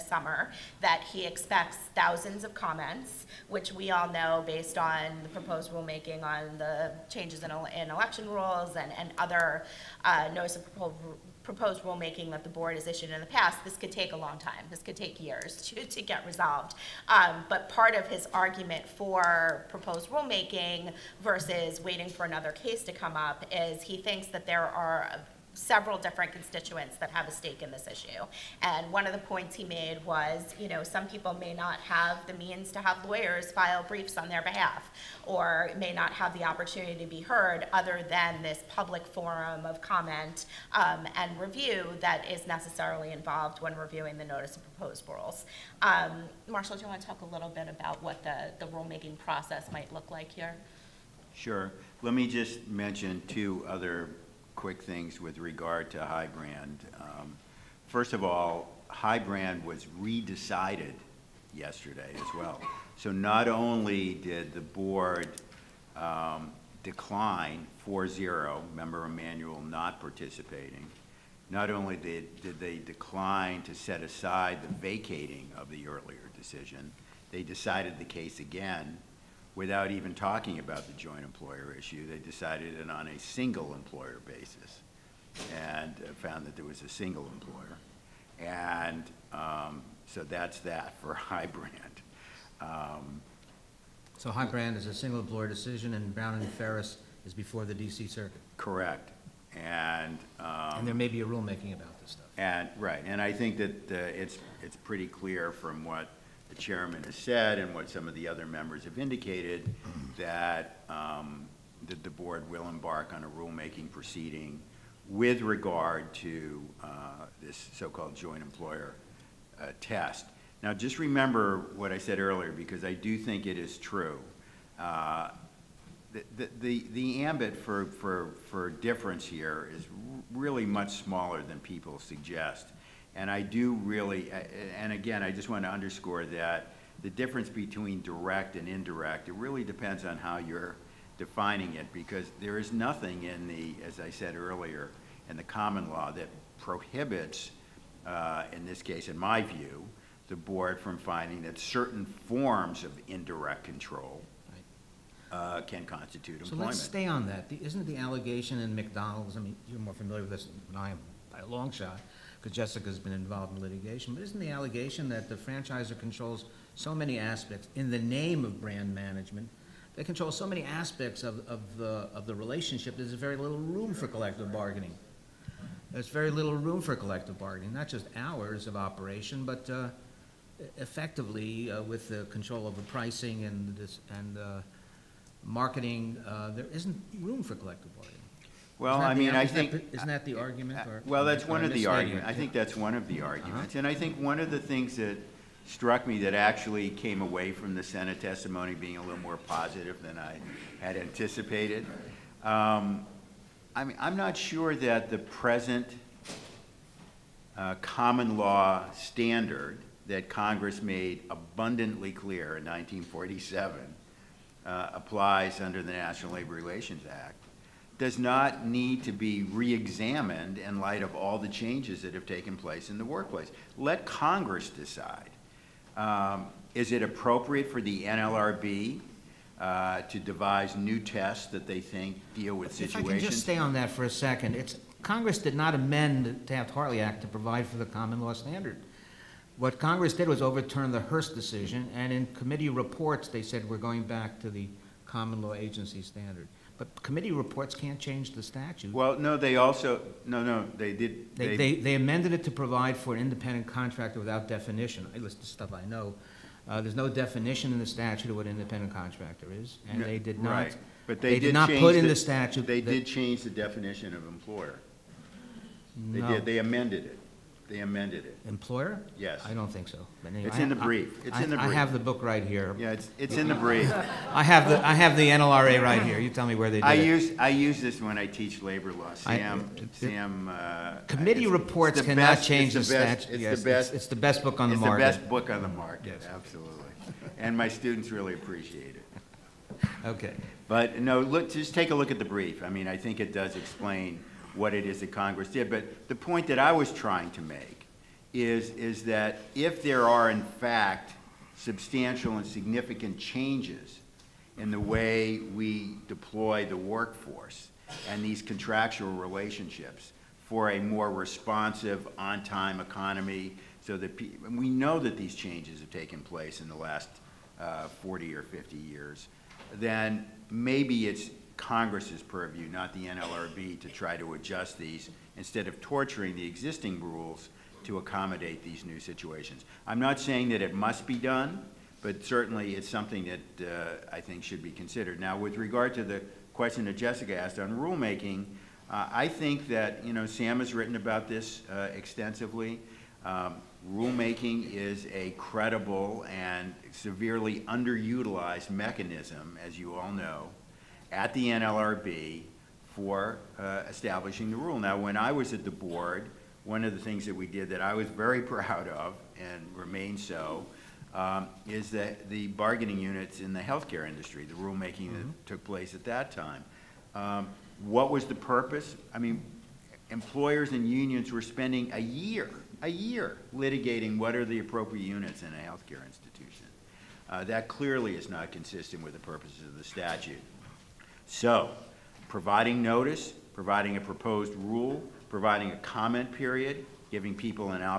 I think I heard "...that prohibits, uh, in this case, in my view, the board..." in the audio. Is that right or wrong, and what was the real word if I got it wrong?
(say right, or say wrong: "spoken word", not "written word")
right.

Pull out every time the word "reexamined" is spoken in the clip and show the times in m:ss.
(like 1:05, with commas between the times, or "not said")
3:39.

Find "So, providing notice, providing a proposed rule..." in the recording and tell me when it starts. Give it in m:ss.
6:21.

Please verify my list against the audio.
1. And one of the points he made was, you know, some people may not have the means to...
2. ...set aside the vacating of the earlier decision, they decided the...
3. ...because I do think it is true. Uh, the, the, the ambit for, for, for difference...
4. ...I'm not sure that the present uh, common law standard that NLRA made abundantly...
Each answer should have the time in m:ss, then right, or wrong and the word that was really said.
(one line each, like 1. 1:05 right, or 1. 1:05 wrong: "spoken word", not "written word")
1. 0:28 right
2. 1:13 right
3. 2:02 right
4. 3:24 wrong: "Congress", not "NLRA".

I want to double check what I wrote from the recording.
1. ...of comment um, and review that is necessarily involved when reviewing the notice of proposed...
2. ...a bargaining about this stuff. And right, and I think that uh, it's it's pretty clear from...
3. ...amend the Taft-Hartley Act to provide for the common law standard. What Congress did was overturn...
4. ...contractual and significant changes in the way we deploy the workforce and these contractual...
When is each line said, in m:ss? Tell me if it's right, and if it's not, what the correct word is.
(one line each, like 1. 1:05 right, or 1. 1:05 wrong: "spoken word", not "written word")
1. 0:39 right
2. 1:41 wrong: "rulemaking", not "bargaining"
3. 3:55 right
4. 5:01 wrong: "substantial", not "contractual".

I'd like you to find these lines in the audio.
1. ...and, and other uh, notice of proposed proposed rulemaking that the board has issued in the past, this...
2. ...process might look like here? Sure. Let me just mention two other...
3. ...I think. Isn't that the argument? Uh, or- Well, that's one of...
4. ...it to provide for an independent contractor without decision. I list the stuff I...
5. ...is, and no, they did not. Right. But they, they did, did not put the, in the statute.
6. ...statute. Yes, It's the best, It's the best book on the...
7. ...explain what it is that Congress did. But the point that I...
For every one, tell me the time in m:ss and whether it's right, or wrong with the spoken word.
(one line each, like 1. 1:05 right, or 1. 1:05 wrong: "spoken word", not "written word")
1. 0:08 right
2. 0:49 right
3. 3:09 right
4. 4:12 wrong: "definition", not "decision"
5. 4:19 right
6. 4:42 right
7. 4:53 right.